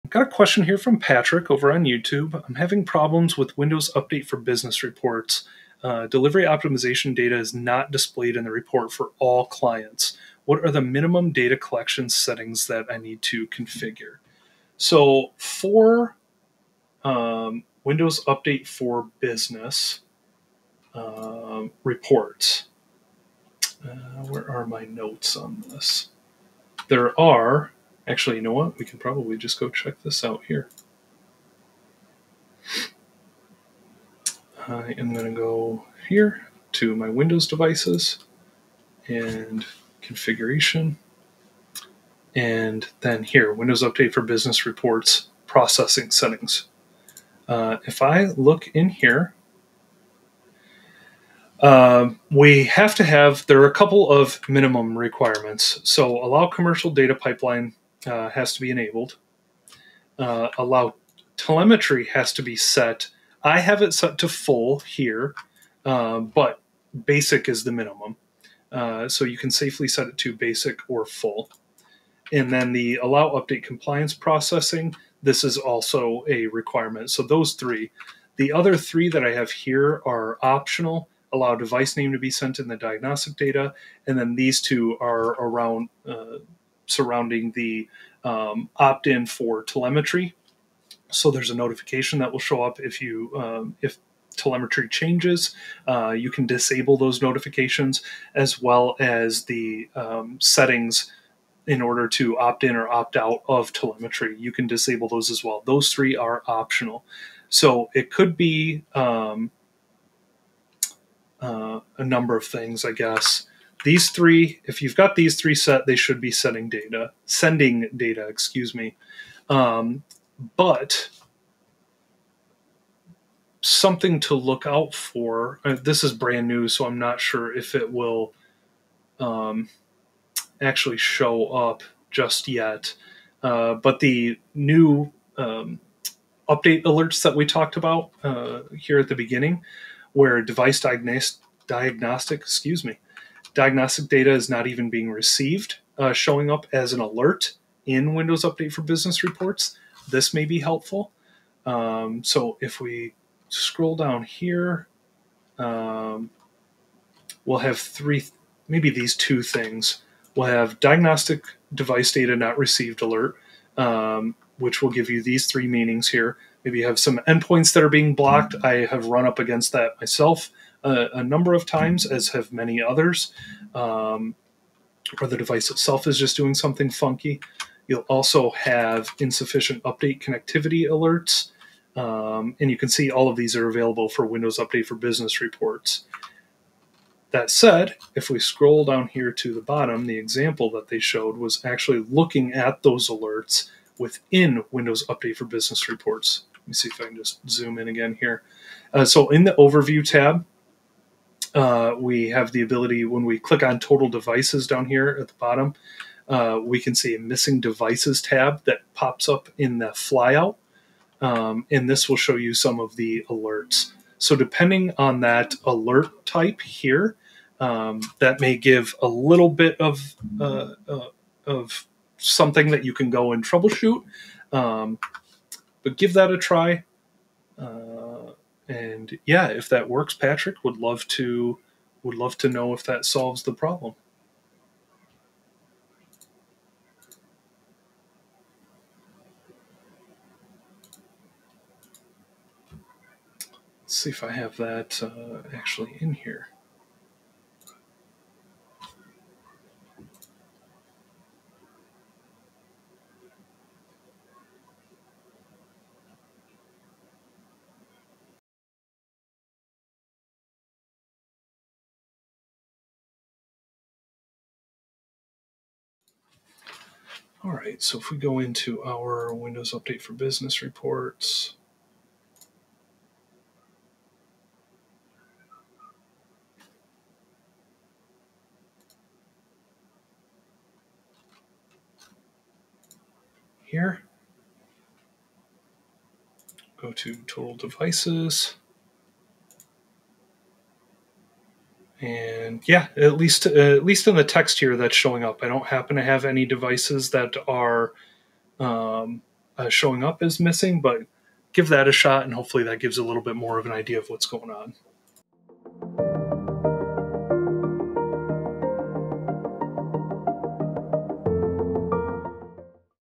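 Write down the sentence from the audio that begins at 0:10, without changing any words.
What are the minimum data collection settings that I need to configure?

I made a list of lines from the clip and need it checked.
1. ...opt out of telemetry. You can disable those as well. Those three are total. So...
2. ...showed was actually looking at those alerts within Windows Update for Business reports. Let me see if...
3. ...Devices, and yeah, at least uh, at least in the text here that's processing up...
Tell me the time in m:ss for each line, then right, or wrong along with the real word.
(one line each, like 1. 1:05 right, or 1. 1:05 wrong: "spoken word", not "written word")
1. 1:42 wrong: "optional", not "total"
2. 3:10 right
3. 4:47 wrong: "showing", not "processing".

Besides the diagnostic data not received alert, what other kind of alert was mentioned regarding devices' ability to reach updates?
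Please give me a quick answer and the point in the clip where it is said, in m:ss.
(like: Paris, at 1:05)
Insufficient update connectivity, at 2:59.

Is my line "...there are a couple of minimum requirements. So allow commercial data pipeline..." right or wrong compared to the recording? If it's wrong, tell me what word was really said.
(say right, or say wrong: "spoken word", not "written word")
right.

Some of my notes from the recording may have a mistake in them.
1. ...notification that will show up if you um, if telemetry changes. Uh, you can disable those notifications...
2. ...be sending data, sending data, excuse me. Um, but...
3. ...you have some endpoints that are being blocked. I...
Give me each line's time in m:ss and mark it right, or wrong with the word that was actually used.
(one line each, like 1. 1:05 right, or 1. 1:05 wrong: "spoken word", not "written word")
1. 1:31 right
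2. 1:56 right
3. 2:46 right.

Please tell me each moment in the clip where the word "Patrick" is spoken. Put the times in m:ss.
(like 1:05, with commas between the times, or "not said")
0:00, 3:50.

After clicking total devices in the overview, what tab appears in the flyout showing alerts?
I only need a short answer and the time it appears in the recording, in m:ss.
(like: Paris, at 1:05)
Missing devices, at 3:27.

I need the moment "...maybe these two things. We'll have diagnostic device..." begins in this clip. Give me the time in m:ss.
2:38.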